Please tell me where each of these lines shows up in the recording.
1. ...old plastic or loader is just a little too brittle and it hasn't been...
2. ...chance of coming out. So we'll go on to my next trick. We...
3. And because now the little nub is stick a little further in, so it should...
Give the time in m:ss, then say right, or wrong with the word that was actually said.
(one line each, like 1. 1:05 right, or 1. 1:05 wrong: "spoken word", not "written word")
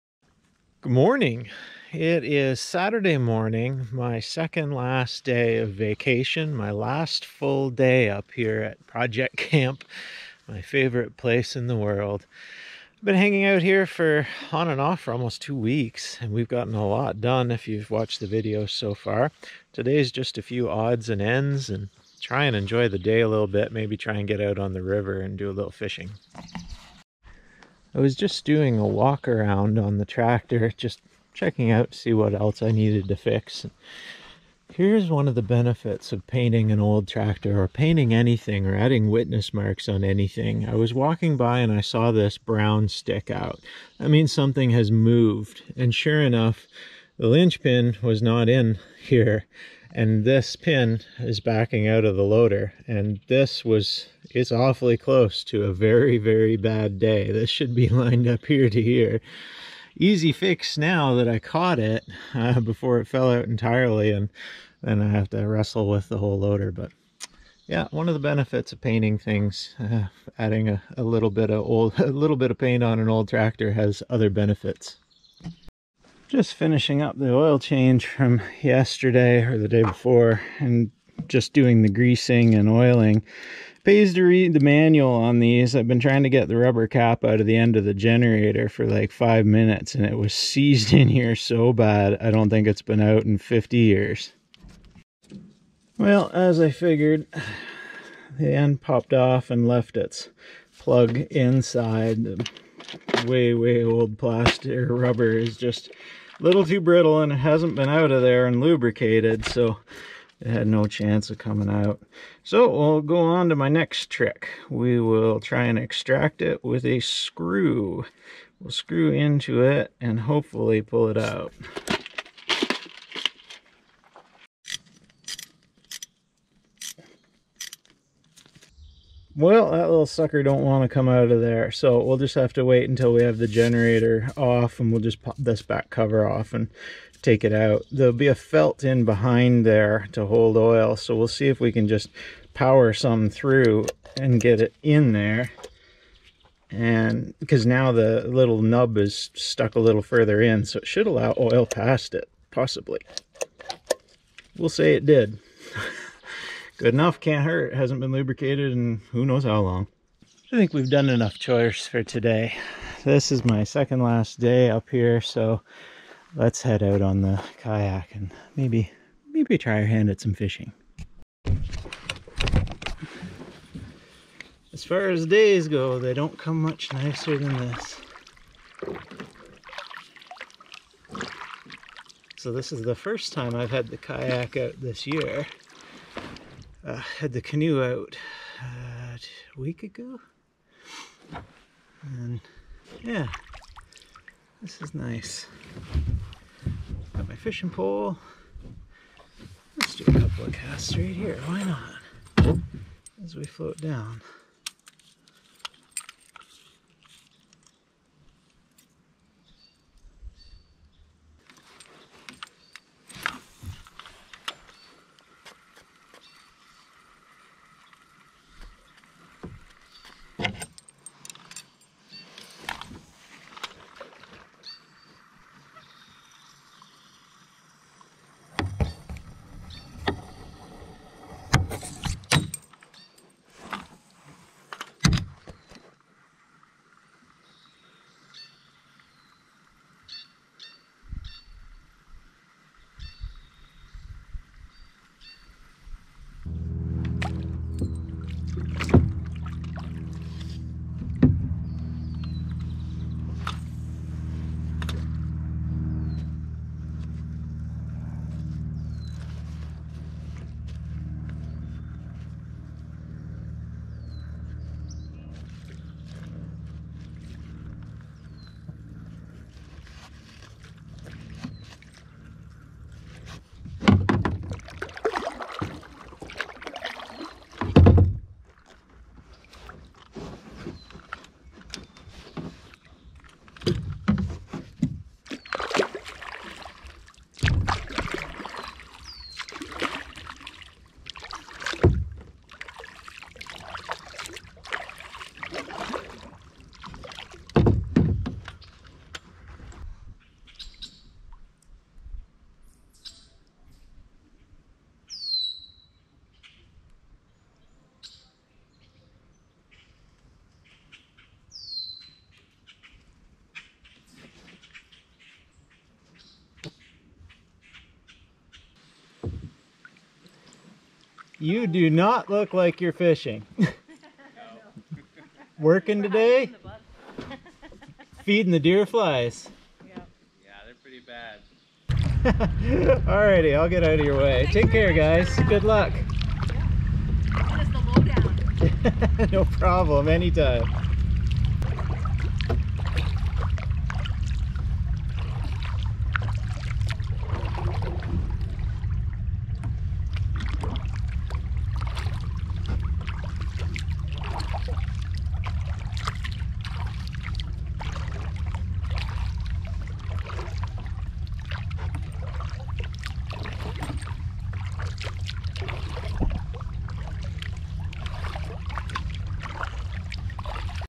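1. 1:43 wrong: "rubber", not "loader"
2. 1:50 right
3. 2:26 wrong: "stuck", not "stick".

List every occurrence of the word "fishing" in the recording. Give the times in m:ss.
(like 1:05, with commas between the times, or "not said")
0:25, 2:50, 3:17, 5:22.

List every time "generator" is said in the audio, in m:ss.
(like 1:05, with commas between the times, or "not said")
1:27, 2:13.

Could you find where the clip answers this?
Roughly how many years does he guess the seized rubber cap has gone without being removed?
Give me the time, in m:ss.
1:33.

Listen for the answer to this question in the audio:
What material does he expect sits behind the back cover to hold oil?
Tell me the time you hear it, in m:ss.
2:18.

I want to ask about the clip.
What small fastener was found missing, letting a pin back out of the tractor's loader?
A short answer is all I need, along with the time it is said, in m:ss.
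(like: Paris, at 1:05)
linchpin, at 0:47.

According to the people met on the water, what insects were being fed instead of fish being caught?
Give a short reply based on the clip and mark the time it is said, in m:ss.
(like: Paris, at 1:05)
deer flies, at 5:28.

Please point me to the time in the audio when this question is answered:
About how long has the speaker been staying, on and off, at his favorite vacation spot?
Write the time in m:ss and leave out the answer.
0:15.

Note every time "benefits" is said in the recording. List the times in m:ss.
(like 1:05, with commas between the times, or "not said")
0:35, 1:08, 1:14.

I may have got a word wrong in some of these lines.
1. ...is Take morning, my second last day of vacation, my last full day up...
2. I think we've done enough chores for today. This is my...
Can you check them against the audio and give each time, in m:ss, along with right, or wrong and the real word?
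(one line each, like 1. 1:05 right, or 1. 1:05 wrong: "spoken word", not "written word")
1. 0:02 wrong: "Saturday", not "Take"
2. 2:40 right.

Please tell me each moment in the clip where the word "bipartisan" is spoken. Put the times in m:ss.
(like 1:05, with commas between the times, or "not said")
not said.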